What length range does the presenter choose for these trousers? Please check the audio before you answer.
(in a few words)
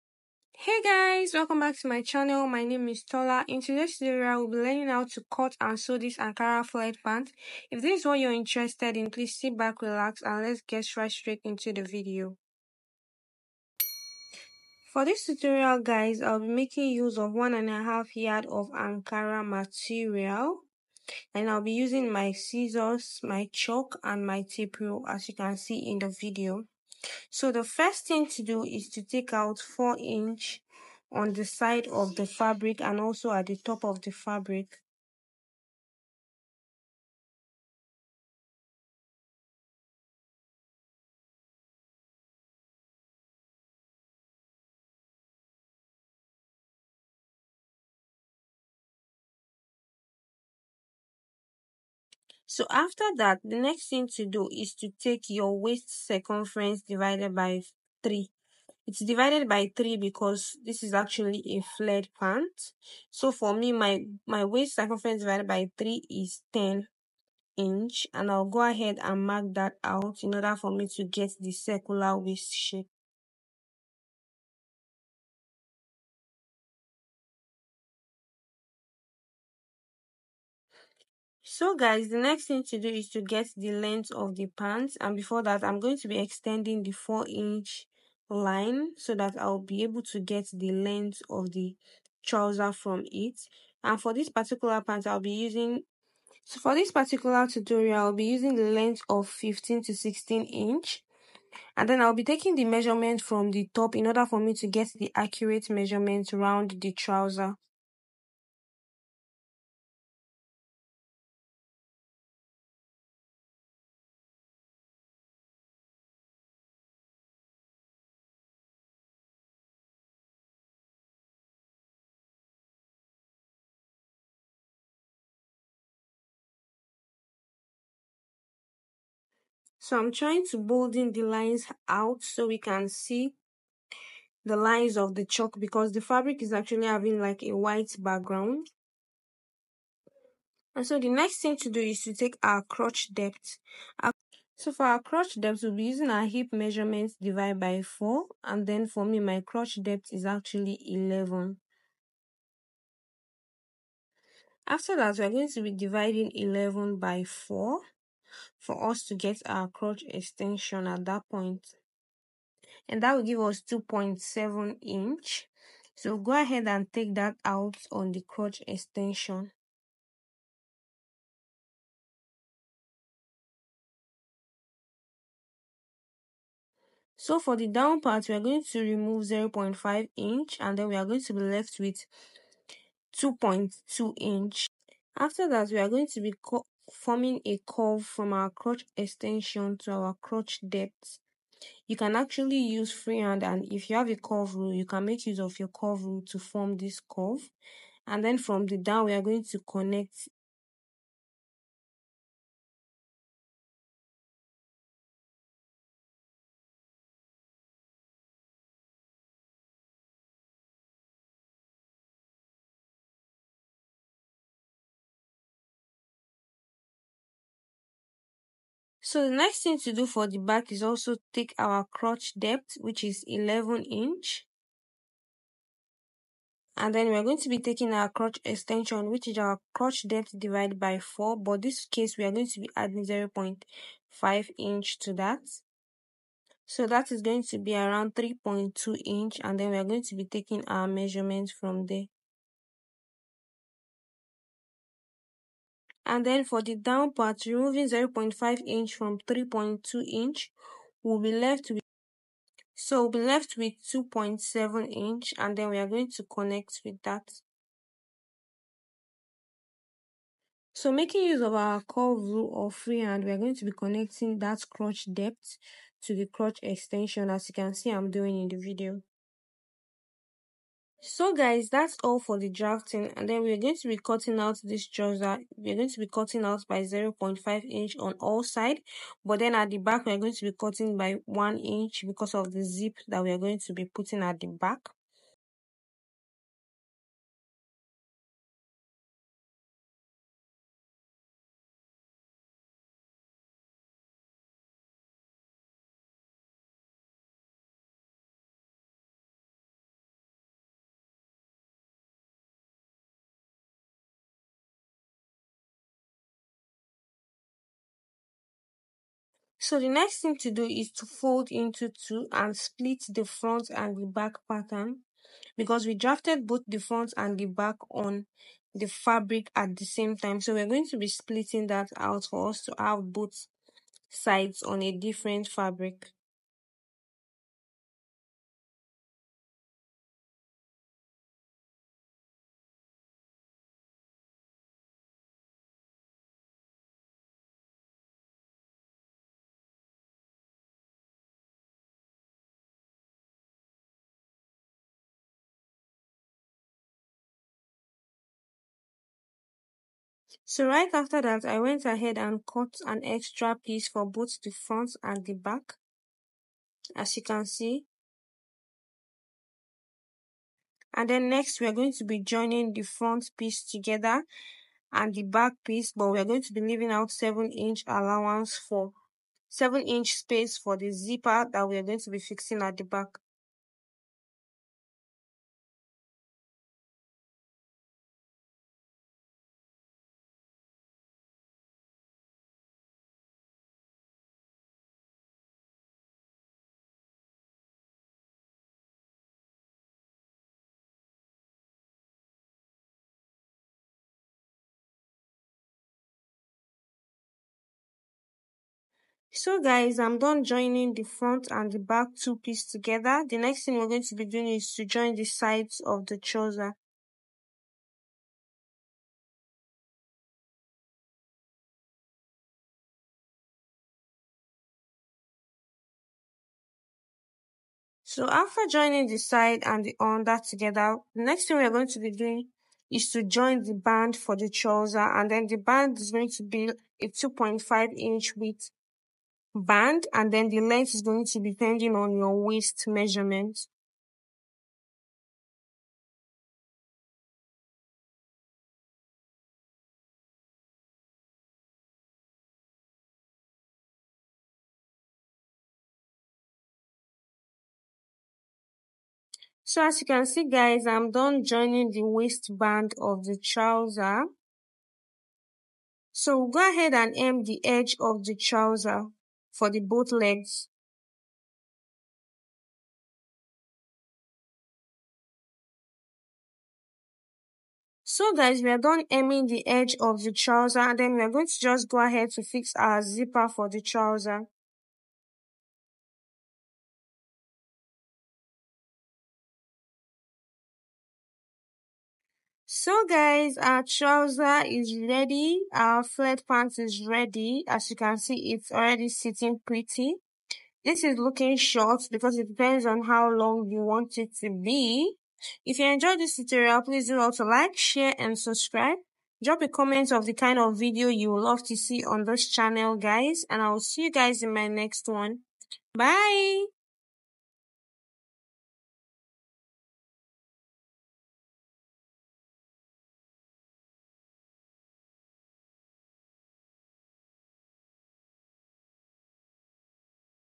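15 to 16 inches.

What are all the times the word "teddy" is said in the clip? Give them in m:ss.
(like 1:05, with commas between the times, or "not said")
not said.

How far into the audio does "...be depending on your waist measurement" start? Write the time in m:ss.
7:11.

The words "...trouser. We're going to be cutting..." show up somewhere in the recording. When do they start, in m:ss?
4:34.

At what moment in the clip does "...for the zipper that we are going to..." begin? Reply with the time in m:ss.
6:10.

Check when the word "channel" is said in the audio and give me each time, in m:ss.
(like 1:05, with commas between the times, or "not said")
0:02, 8:22.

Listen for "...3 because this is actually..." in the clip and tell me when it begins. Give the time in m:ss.
0:59.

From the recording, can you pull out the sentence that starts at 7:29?
So as you can see guys, I'm done joining the waistband of the trouser.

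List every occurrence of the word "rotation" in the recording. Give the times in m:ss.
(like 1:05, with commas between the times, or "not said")
not said.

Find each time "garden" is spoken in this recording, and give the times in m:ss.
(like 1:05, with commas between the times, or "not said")
not said.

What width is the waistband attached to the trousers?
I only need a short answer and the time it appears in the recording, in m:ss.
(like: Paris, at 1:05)
2.5 inches, at 7:07.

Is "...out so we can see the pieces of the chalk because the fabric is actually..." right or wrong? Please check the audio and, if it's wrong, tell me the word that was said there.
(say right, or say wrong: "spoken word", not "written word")
wrong: "lines", not "pieces".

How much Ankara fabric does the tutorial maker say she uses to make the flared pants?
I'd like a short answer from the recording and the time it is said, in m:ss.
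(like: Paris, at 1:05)
1.5 yards, at 0:17.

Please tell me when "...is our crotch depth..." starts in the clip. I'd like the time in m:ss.
3:49.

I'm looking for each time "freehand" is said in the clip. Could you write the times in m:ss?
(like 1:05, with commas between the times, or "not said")
3:12, 4:22.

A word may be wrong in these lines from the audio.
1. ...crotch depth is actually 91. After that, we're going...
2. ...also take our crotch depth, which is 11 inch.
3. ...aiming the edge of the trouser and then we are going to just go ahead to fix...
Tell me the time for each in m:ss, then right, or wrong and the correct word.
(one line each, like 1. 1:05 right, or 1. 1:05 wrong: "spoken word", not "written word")
1. 2:29 wrong: "11", not "91"
2. 3:40 right
3. 7:49 right.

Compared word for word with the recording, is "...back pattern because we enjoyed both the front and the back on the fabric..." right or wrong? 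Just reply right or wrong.
wrong.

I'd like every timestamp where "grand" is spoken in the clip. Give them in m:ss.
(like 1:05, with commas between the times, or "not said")
not said.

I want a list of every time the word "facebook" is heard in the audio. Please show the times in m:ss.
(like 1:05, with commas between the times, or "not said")
not said.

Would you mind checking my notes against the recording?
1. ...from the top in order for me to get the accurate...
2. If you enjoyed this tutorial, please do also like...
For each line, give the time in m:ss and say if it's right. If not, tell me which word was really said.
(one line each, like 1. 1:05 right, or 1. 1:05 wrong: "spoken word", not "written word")
1. 1:43 right
2. 8:15 right.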